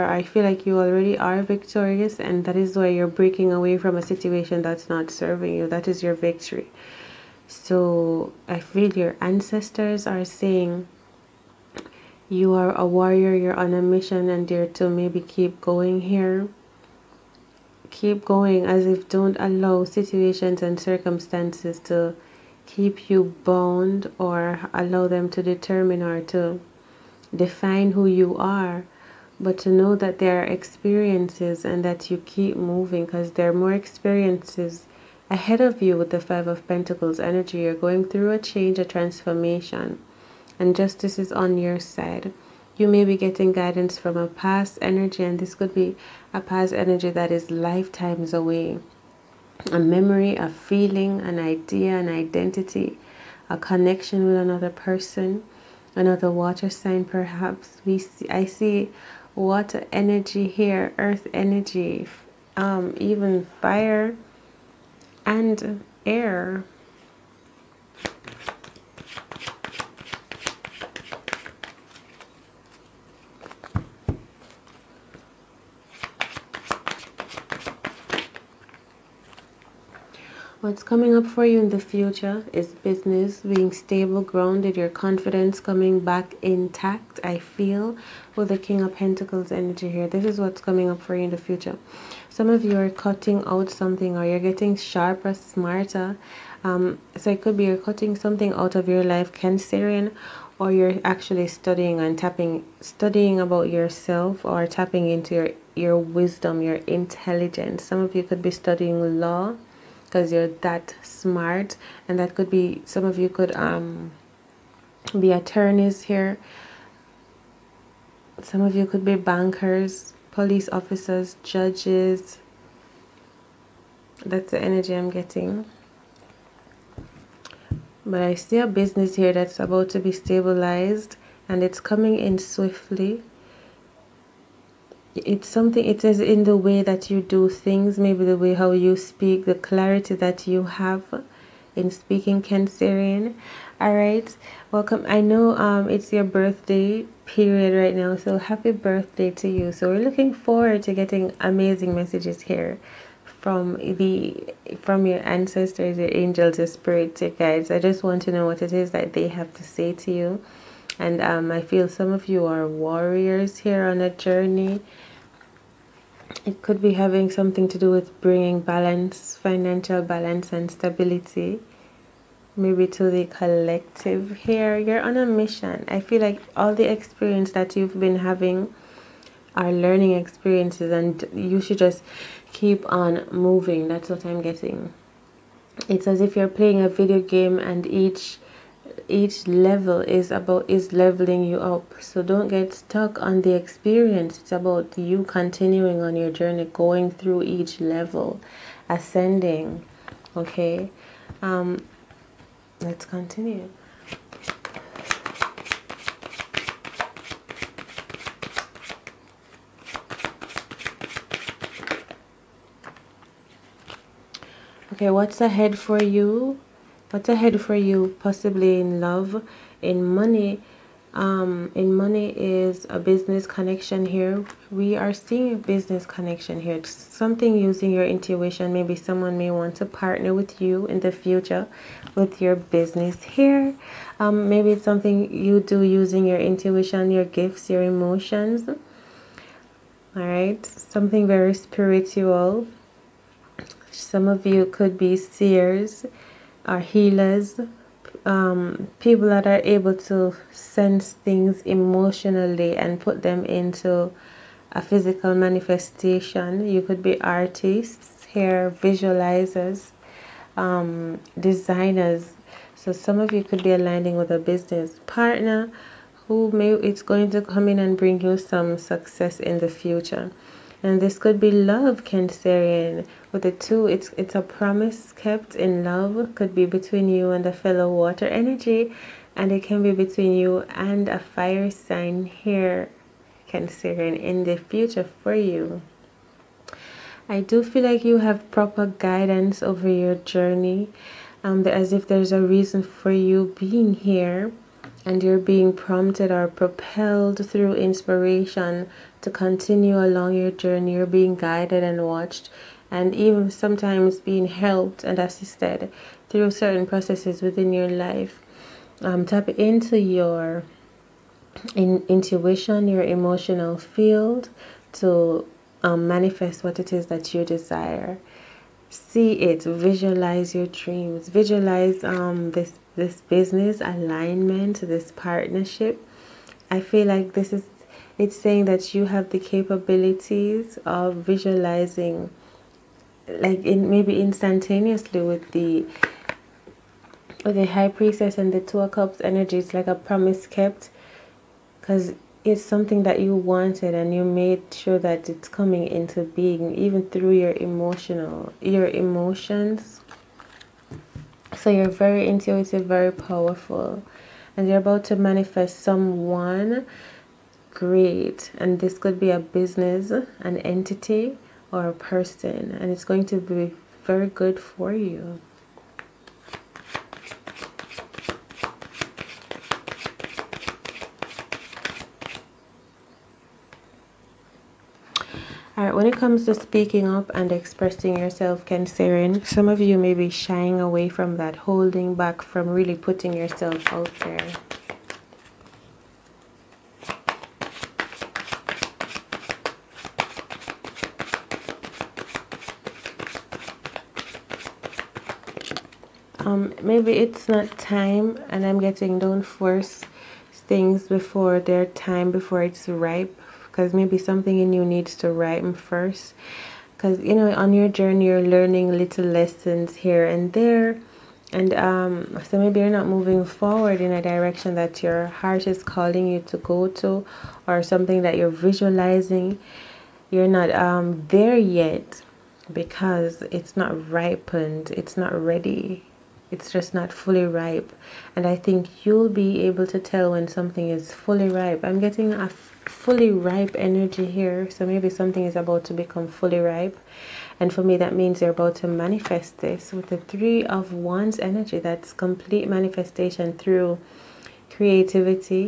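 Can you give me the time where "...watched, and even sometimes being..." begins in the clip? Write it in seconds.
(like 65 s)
302 s.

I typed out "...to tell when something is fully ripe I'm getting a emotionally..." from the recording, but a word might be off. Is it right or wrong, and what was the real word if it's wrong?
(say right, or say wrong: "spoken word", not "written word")
wrong: "fully", not "emotionally".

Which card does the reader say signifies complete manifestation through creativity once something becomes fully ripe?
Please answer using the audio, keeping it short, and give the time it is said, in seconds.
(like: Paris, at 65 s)
Three of Wands, at 440 s.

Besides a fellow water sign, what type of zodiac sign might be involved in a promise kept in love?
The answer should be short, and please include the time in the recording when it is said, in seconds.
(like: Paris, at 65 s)
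fire sign, at 281 s.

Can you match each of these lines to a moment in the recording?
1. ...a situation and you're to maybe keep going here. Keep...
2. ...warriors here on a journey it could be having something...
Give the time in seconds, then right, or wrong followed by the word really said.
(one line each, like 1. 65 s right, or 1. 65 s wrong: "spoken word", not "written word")
1. 13 s wrong: "mission", not "situation"
2. 162 s right.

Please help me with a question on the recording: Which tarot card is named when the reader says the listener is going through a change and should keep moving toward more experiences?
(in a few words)
Five of Pentacles.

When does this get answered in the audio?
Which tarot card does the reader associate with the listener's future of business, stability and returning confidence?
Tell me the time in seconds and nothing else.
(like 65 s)
88 s.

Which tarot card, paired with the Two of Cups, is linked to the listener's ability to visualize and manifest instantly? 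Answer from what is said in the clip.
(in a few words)
High Priestess.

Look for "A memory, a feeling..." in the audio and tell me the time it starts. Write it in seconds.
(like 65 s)
49 s.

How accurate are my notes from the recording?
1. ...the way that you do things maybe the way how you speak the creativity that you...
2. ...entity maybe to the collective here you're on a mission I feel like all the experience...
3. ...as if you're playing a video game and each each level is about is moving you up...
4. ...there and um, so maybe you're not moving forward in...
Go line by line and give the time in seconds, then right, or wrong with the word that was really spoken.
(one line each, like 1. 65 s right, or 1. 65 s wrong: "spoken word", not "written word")
1. 136 s wrong: "clarity", not "creativity"
2. 170 s wrong: "stability", not "entity"
3. 186 s wrong: "leveling", not "moving"
4. 410 s right.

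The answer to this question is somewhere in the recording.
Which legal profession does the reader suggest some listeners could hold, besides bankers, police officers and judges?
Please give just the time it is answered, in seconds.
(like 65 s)
115 s.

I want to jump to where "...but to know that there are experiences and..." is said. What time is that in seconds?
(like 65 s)
29 s.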